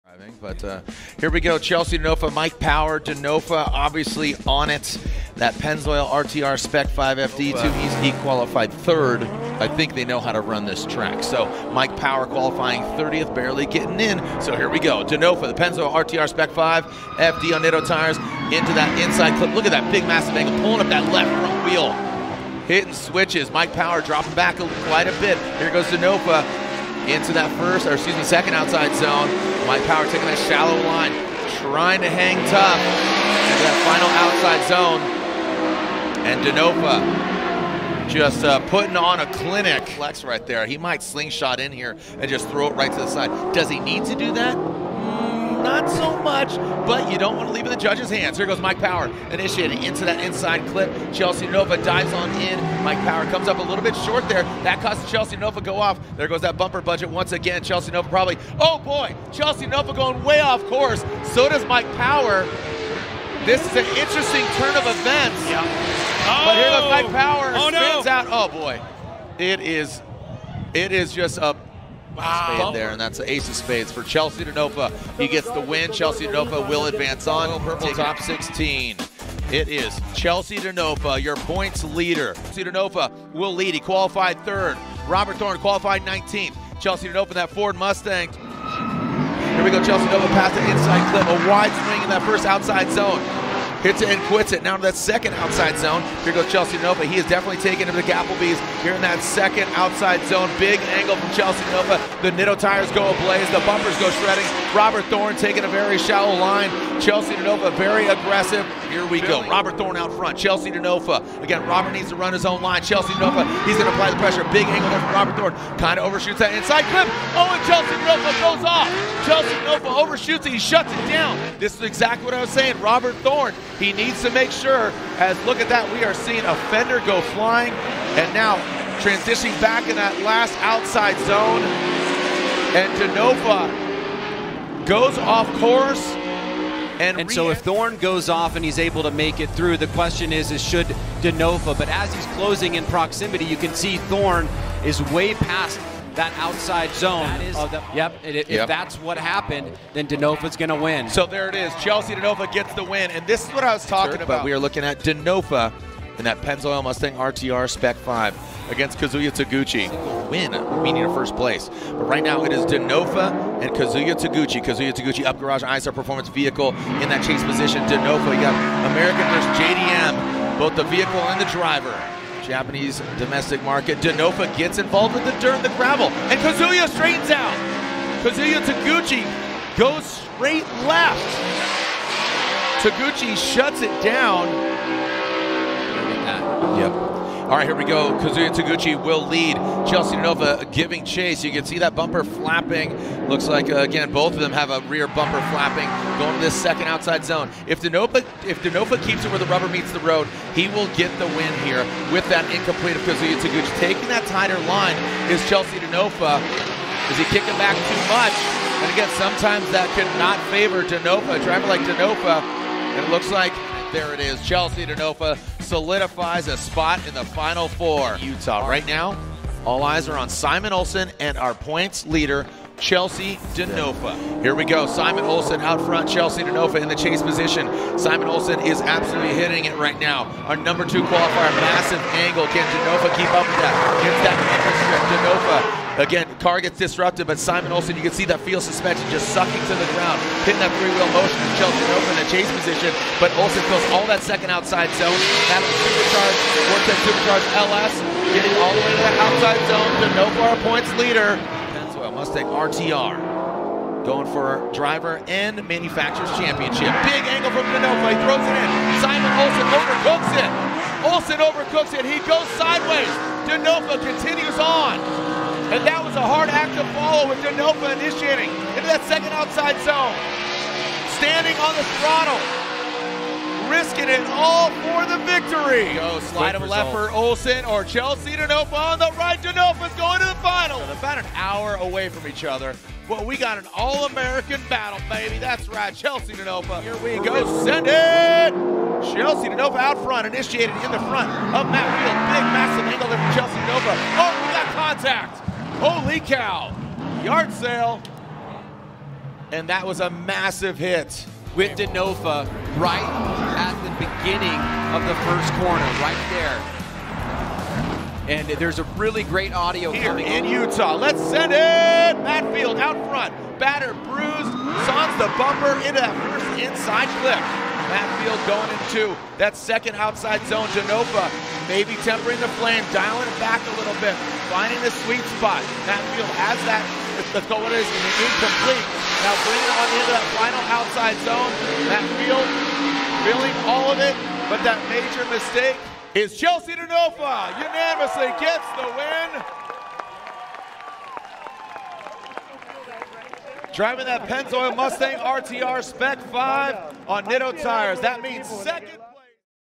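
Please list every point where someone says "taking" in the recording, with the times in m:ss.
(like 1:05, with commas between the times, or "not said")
0:30, 1:37, 1:45, 3:23.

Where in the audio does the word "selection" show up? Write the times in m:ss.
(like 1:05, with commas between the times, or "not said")
not said.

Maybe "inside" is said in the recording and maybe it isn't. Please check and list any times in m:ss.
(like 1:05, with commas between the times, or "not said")
0:18, 0:50, 1:30, 1:56, 5:16.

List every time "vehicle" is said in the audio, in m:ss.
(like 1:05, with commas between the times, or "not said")
2:46, 2:50.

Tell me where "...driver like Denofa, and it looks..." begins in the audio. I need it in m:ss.
3:31.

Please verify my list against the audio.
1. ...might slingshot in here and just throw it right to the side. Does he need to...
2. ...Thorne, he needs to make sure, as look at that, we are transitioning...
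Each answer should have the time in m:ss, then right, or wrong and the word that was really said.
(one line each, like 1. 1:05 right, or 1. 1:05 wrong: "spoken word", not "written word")
1. 0:40 right
2. 2:03 wrong: "seeing", not "transitioning".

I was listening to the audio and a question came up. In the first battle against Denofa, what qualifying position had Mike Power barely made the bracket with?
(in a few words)
30th.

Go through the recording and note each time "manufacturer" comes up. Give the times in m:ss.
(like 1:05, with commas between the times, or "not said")
4:15.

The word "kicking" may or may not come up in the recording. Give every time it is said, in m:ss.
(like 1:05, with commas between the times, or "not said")
3:27.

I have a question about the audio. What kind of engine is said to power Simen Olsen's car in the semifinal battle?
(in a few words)
Supercharged LS.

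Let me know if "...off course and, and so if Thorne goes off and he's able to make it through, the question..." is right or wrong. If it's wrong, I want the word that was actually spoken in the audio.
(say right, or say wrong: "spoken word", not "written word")
right.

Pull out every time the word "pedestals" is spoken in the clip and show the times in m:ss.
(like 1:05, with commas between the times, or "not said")
not said.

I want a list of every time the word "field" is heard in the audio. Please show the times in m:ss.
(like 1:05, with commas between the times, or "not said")
3:58, 4:51, 5:12, 5:18, 5:26, 5:32.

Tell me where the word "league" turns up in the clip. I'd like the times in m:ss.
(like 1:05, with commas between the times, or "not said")
not said.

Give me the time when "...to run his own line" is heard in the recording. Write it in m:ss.
1:52.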